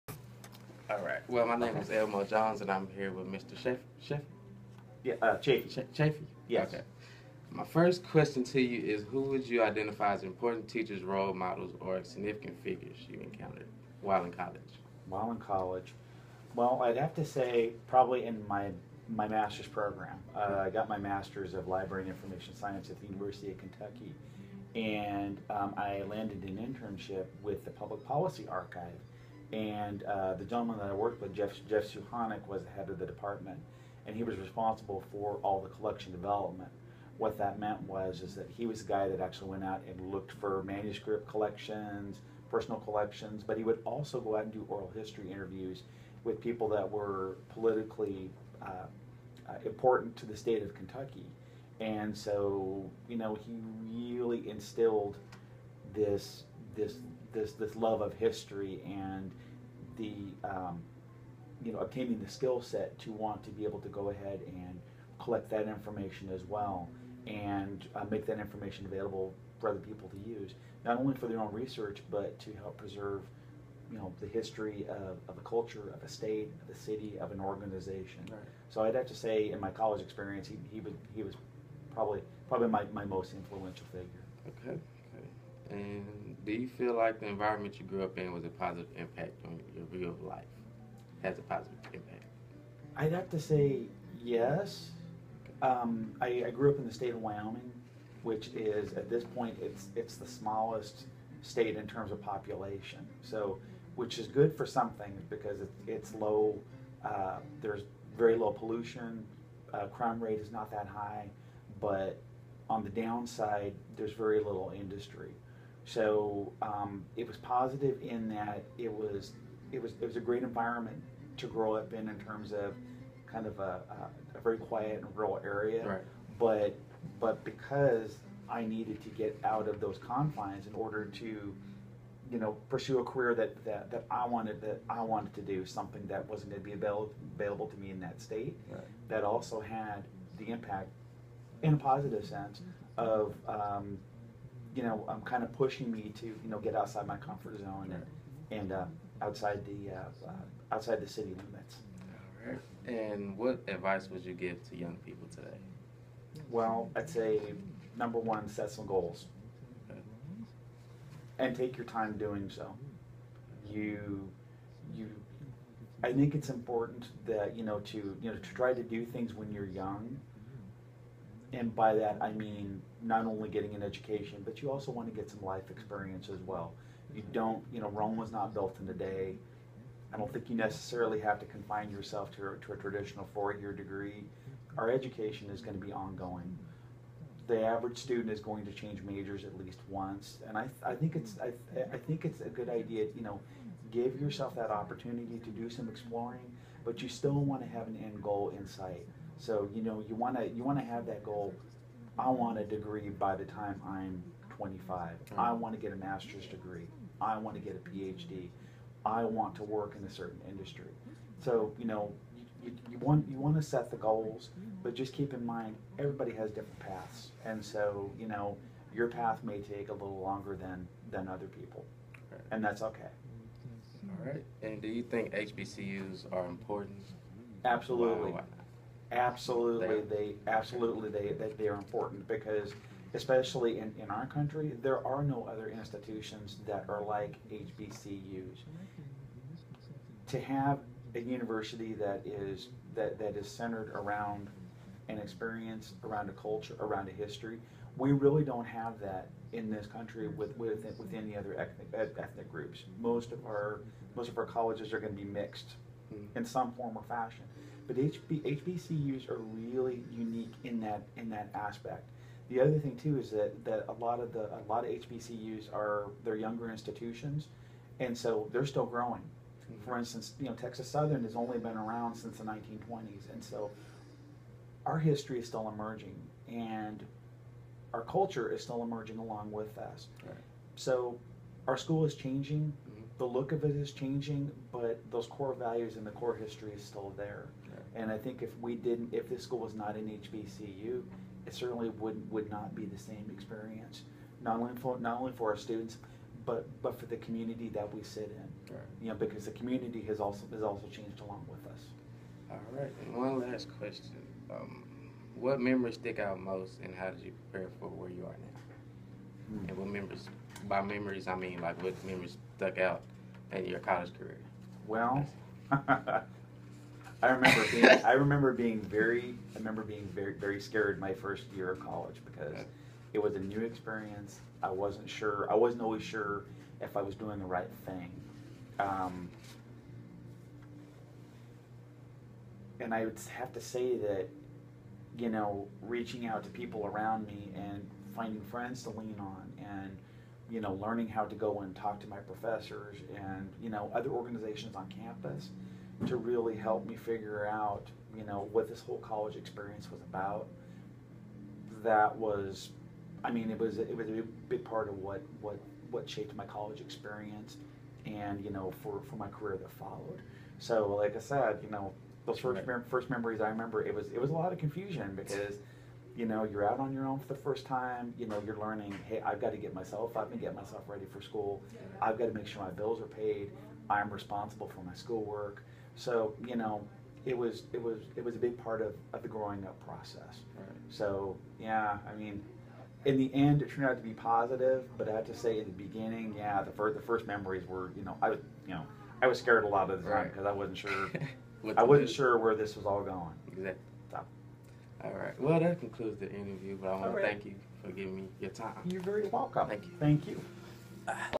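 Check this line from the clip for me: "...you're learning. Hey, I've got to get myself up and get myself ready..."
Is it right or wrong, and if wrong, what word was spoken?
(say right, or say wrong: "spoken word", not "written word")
right.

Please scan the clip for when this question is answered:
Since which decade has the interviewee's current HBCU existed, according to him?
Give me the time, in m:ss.
4:32.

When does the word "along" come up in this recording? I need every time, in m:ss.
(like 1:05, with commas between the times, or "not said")
4:39, 5:01.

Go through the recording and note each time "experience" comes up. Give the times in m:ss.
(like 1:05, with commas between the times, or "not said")
1:20, 2:55, 4:05, 4:53, 5:23, 5:49, 5:56.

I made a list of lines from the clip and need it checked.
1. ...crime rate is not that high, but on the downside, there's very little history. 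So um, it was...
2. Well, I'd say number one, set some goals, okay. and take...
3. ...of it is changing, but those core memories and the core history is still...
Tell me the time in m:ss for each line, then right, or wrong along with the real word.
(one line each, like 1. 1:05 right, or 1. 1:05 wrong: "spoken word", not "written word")
1. 1:49 wrong: "industry", not "history"
2. 2:36 right
3. 4:43 wrong: "values", not "memories".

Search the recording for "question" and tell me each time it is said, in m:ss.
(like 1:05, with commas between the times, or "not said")
0:08, 5:03.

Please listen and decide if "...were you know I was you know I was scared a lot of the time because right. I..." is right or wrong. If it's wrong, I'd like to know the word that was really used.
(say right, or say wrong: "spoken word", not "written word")
right.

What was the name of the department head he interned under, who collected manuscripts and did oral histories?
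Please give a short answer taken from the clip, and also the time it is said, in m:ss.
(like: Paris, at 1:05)
Jeff Suchanek, at 0:31.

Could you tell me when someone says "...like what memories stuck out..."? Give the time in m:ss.
5:11.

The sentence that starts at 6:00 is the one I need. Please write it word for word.
So, like I said, you know, those first right.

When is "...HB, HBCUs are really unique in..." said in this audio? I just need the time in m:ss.
4:18.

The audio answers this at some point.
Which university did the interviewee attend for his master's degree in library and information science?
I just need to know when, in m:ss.
0:23.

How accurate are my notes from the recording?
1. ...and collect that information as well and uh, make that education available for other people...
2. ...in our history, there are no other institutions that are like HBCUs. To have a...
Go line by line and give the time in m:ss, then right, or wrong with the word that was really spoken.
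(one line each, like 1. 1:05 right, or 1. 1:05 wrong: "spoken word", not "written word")
1. 1:04 wrong: "information", not "education"
2. 3:54 wrong: "country", not "history".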